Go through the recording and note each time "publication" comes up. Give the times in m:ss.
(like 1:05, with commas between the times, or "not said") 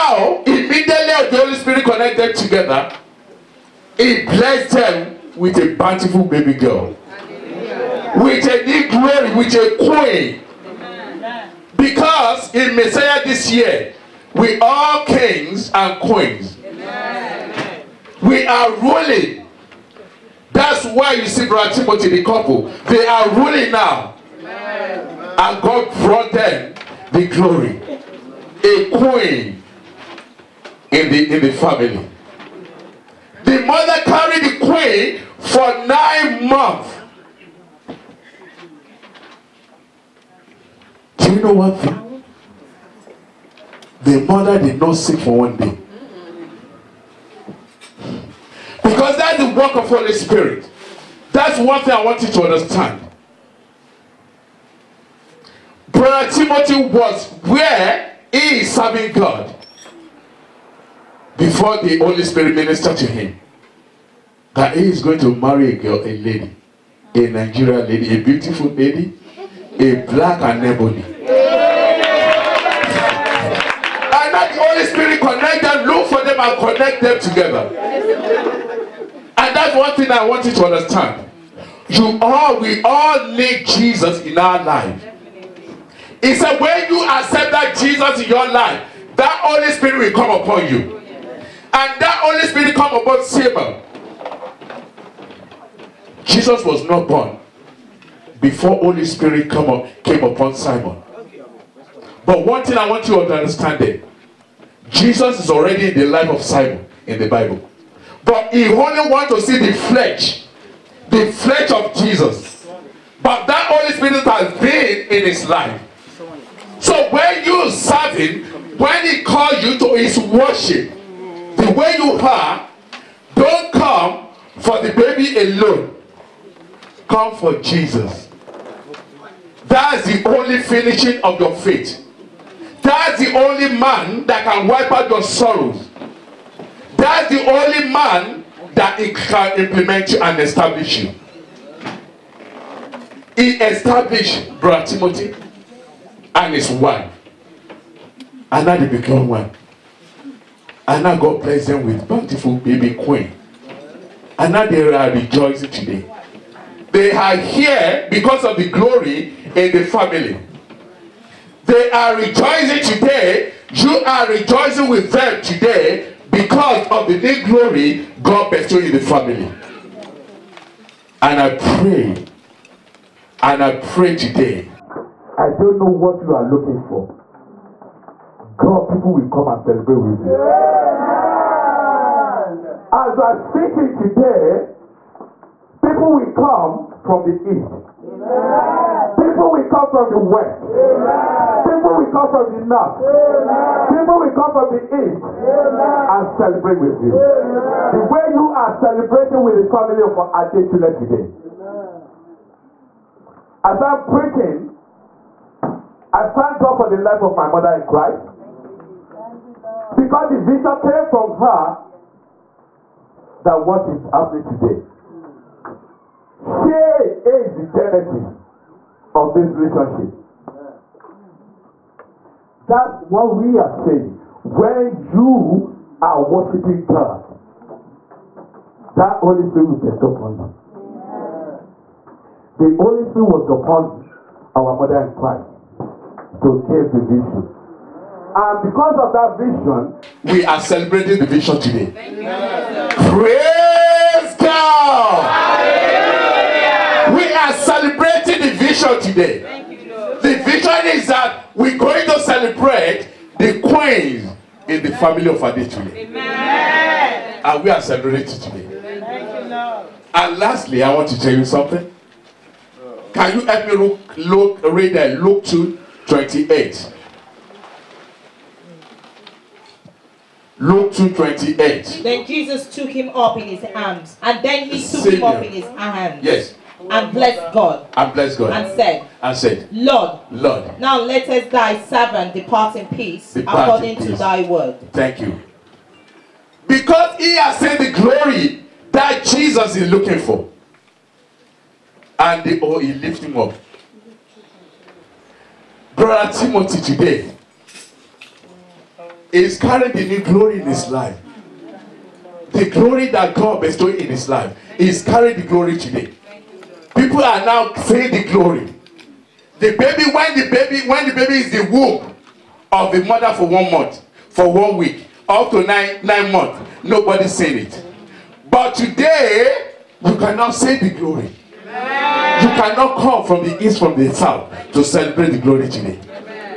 not said.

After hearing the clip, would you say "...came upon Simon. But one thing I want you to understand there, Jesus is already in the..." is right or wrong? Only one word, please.
right.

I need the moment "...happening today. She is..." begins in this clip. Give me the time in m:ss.
3:34.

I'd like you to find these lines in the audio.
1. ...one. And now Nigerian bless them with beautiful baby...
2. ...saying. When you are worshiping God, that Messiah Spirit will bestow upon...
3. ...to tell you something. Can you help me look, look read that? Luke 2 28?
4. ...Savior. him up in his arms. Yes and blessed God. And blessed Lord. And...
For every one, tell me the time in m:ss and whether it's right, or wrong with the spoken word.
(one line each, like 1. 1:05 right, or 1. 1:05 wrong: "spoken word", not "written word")
1. 2:29 wrong: "God", not "Nigerian"
2. 3:43 wrong: "Holy", not "Messiah"
3. 4:21 right
4. 4:35 wrong: "God", not "Lord".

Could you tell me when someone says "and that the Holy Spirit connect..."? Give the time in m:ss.
1:11.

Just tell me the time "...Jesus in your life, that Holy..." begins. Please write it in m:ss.
1:27.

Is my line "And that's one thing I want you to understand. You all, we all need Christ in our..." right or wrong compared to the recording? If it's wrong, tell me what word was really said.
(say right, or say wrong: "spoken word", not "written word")
wrong: "Jesus", not "Christ".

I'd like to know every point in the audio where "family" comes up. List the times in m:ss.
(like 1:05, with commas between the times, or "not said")
0:31, 2:39, 2:48, 3:19, 4:14.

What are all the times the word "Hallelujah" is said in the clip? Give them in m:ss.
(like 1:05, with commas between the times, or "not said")
0:07, 4:05.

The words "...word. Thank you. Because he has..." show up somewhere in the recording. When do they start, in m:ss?
4:44.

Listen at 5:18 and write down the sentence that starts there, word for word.
But today, you cannot say the glory.